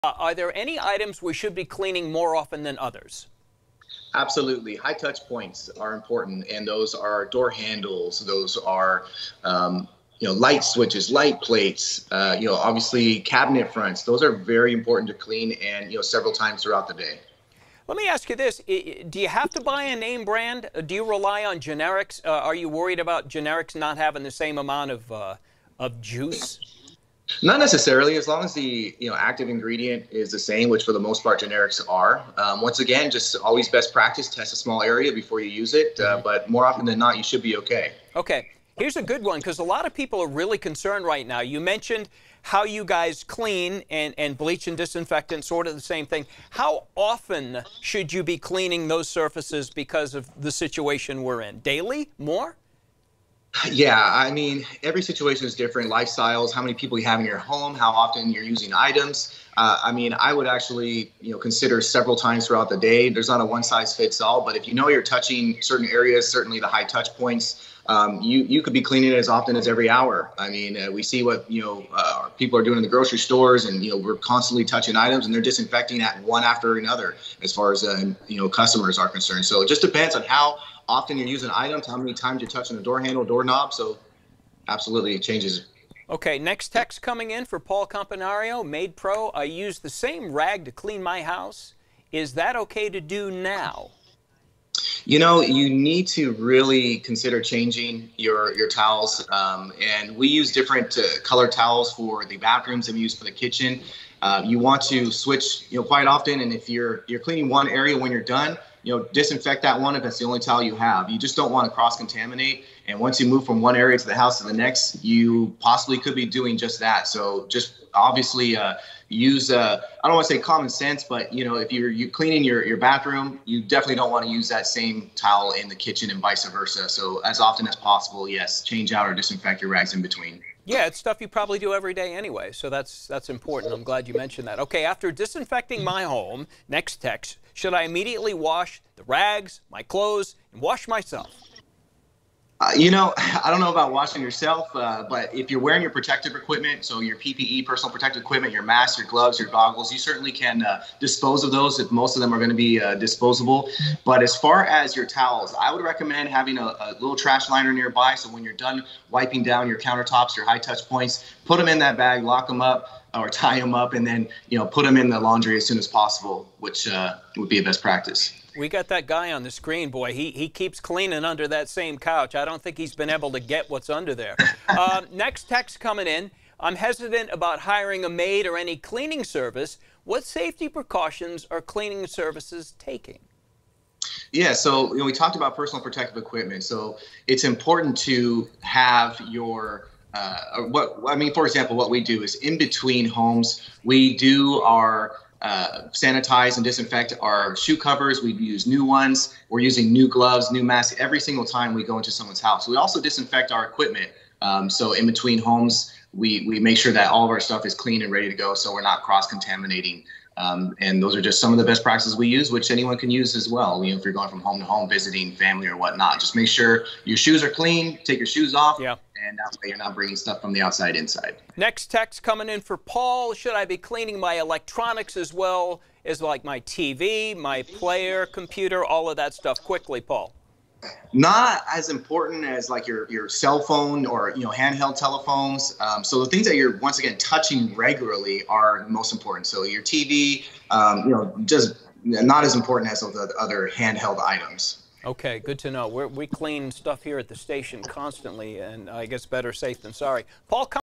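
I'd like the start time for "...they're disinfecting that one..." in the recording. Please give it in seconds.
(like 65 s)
75 s.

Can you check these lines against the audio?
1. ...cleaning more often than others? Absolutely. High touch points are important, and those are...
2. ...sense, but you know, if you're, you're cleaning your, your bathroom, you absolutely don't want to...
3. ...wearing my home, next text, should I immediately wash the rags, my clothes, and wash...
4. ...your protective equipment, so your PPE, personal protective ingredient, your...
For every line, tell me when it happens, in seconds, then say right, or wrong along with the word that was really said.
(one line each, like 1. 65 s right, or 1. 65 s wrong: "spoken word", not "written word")
1. 1 s right
2. 120 s wrong: "definitely", not "absolutely"
3. 135 s wrong: "disinfecting", not "wearing"
4. 145 s wrong: "equipment", not "ingredient".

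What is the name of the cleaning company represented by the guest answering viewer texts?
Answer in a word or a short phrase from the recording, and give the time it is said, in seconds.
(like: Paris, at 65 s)
MaidPro, at 88 s.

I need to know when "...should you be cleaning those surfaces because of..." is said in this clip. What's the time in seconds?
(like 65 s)
47 s.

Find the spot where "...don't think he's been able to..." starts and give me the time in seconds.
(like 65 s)
172 s.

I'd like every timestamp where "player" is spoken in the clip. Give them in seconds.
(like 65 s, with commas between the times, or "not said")
227 s.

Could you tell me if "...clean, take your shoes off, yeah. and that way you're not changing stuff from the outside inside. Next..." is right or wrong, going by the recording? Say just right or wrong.
wrong.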